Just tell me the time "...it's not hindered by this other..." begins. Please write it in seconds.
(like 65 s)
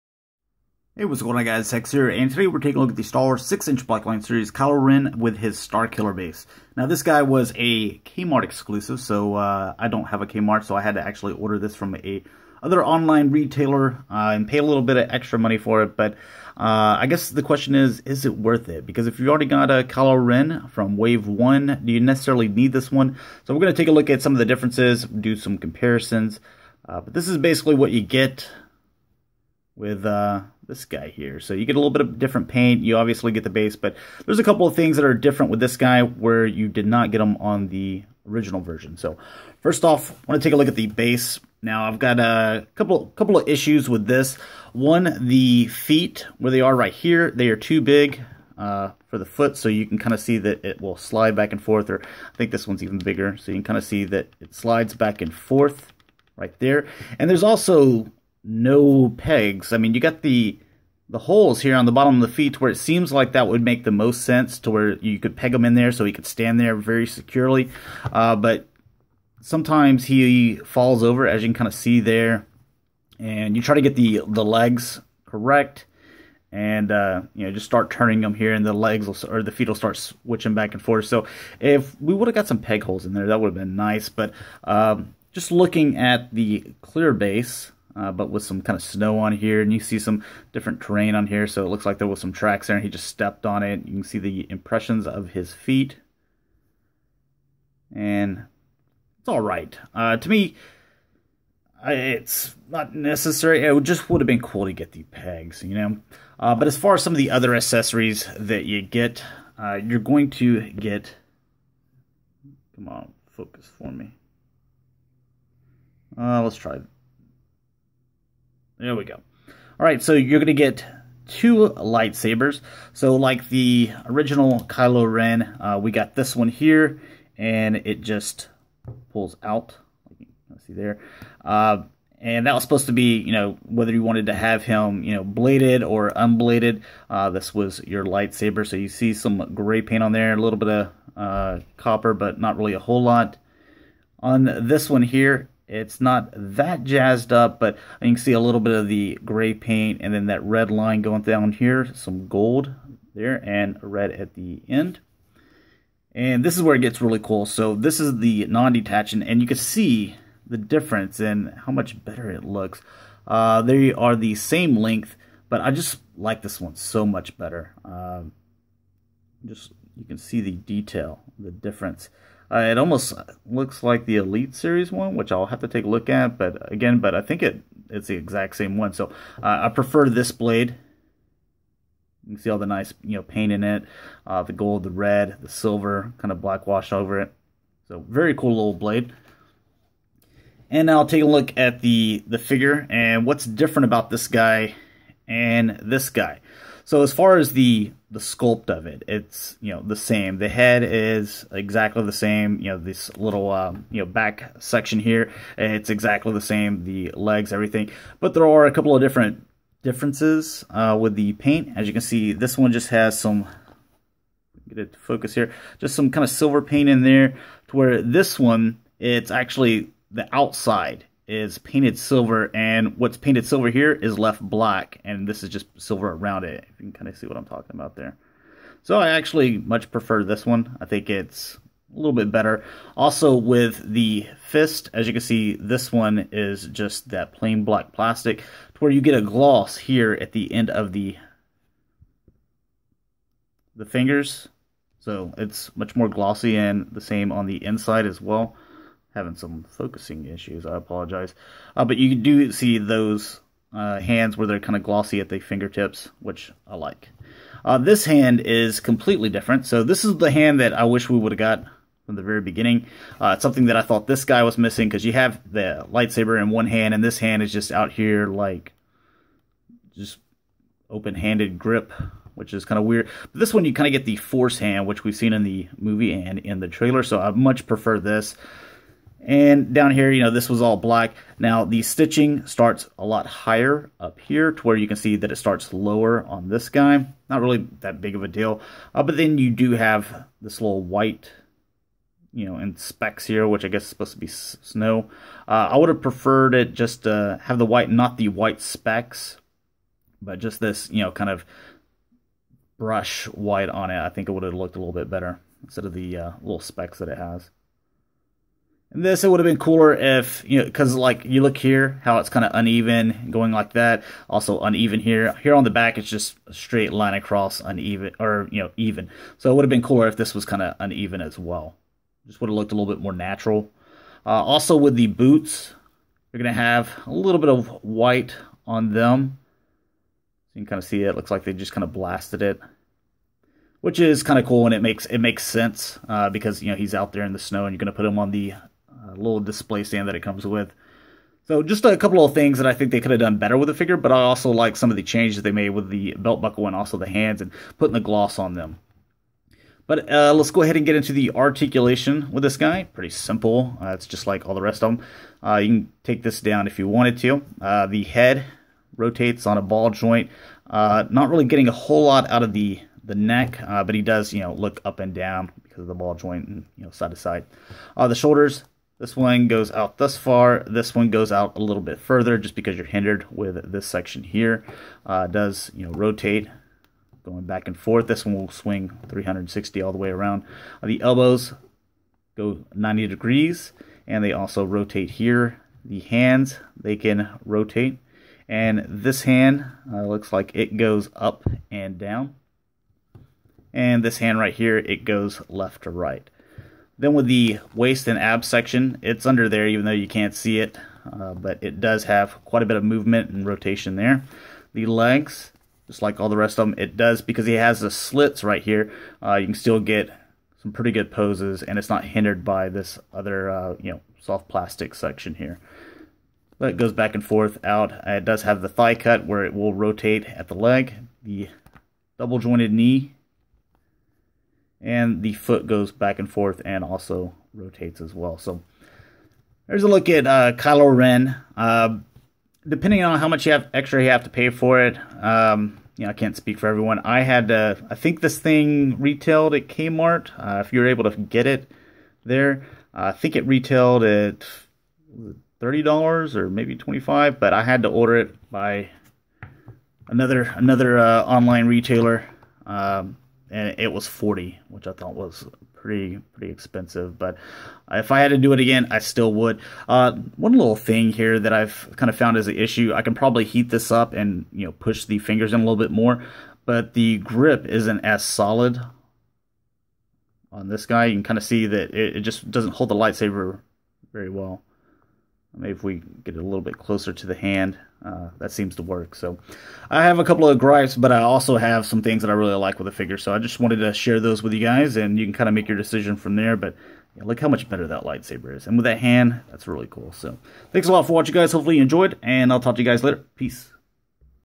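411 s.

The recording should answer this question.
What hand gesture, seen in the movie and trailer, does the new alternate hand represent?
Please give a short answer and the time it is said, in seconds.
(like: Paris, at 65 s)
Force hand, at 274 s.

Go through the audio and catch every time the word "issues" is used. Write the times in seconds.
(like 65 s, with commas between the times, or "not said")
43 s, 250 s, 462 s.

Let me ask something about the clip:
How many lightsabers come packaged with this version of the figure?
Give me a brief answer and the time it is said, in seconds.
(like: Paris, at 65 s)
2, at 121 s.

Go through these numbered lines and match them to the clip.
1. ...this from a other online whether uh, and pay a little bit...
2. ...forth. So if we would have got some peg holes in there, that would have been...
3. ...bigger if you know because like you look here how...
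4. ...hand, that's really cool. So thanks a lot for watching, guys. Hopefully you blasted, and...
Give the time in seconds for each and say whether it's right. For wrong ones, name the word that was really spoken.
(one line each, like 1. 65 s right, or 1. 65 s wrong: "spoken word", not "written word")
1. 11 s wrong: "retailer", not "whether"
2. 80 s right
3. 309 s wrong: "cooler", not "bigger"
4. 488 s wrong: "enjoyed", not "blasted".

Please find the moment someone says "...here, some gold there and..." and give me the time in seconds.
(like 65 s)
151 s.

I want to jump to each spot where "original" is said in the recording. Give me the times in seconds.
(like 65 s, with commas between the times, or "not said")
38 s, 124 s.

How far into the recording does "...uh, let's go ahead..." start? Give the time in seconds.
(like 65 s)
350 s.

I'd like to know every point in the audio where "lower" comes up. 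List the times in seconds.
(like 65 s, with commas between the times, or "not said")
285 s.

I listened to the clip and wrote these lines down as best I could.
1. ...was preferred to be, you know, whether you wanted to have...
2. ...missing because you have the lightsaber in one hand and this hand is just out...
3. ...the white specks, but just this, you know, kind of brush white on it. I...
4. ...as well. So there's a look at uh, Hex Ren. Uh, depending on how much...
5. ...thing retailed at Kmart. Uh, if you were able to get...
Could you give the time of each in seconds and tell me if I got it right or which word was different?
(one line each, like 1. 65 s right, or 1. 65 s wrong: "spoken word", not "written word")
1. 132 s wrong: "supposed", not "preferred"
2. 264 s right
3. 298 s right
4. 428 s wrong: "Kylo", not "Hex"
5. 438 s right.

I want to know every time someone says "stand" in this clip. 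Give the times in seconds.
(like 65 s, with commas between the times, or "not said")
66 s, 339 s.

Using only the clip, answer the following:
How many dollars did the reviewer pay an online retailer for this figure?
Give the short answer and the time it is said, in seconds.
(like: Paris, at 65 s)
40, at 454 s.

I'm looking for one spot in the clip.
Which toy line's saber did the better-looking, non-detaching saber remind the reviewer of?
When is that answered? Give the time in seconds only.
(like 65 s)
174 s.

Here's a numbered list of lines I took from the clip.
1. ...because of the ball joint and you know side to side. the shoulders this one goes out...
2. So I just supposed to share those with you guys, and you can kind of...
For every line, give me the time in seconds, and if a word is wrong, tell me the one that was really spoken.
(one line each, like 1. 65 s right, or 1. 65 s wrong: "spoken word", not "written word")
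1. 365 s right
2. 483 s wrong: "wanted", not "supposed".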